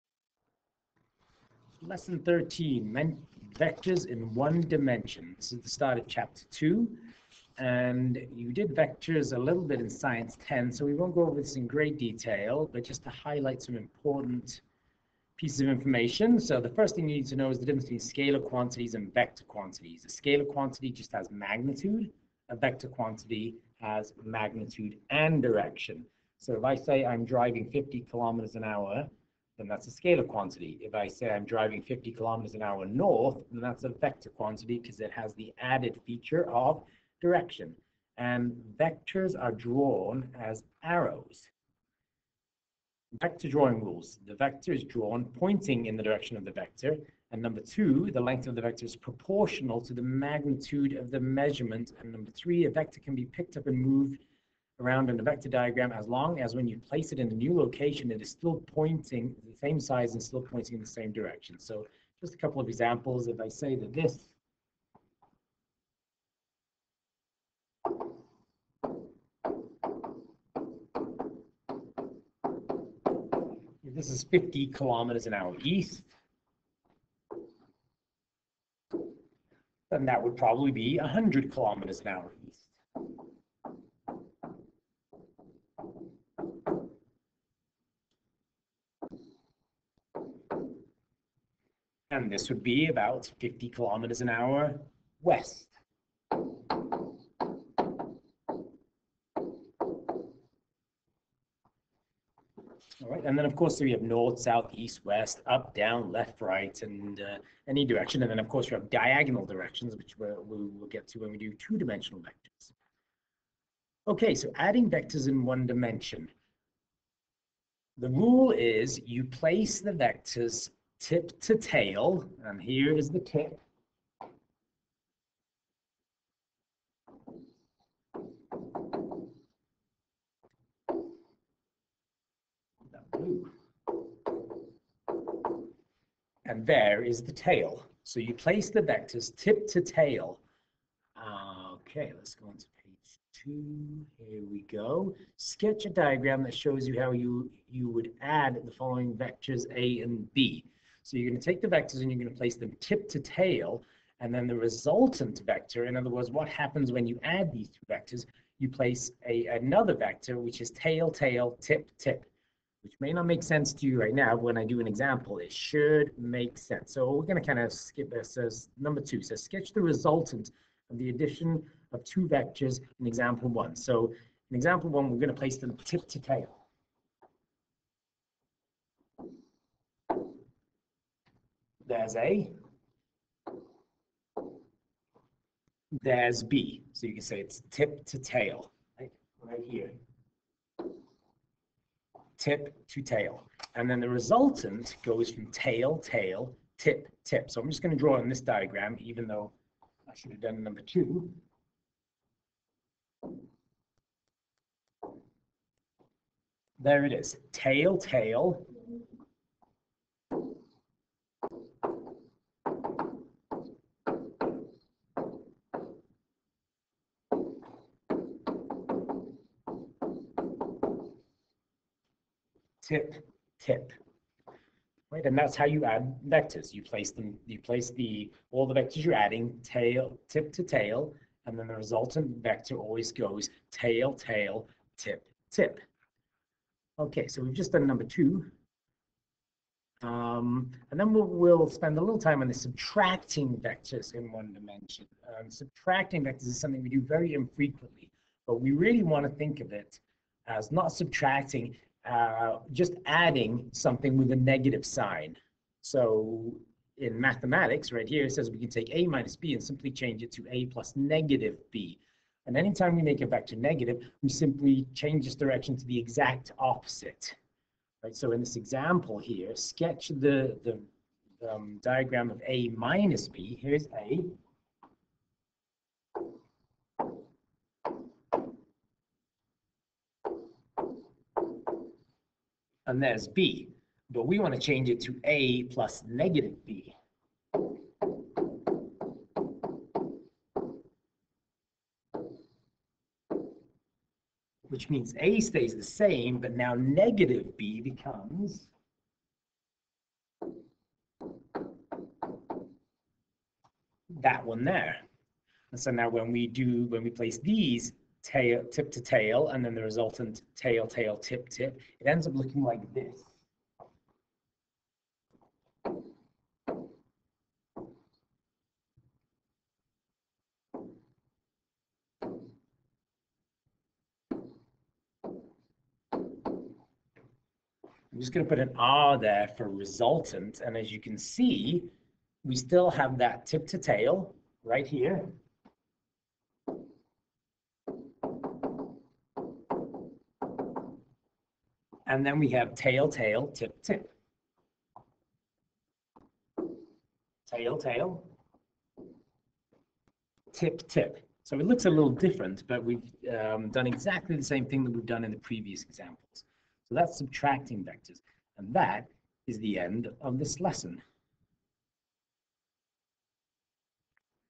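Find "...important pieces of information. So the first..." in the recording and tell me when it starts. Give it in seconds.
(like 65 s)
13 s.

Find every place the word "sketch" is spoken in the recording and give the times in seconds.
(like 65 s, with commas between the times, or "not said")
145 s, 169 s, 269 s.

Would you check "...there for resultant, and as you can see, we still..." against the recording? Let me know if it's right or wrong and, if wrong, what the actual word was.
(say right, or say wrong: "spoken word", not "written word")
right.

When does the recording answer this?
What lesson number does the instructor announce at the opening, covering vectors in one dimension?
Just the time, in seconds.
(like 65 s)
1 s.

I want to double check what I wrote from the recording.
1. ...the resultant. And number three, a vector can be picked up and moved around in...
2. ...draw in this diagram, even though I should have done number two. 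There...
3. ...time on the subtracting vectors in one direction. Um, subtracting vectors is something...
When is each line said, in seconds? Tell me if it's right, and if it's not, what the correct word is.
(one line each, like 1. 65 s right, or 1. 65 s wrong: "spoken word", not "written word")
1. 51 s wrong: "measurement", not "resultant"
2. 197 s right
3. 242 s wrong: "dimension", not "direction".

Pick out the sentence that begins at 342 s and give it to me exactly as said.
And then we have tail, tail, tip, tip.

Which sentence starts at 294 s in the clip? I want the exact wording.
Which means A stays the same, but now negative B becomes that one there.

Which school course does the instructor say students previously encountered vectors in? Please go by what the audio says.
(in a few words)
Science 10.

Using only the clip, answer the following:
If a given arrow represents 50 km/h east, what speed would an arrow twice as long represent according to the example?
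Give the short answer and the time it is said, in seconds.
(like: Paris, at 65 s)
100 kilometers an hour east, at 80 s.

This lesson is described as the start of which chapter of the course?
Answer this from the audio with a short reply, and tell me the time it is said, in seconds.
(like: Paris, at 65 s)
Chapter 2, at 6 s.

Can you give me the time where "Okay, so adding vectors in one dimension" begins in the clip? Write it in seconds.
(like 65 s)
114 s.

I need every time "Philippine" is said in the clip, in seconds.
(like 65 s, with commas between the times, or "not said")
not said.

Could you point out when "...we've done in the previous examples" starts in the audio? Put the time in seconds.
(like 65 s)
354 s.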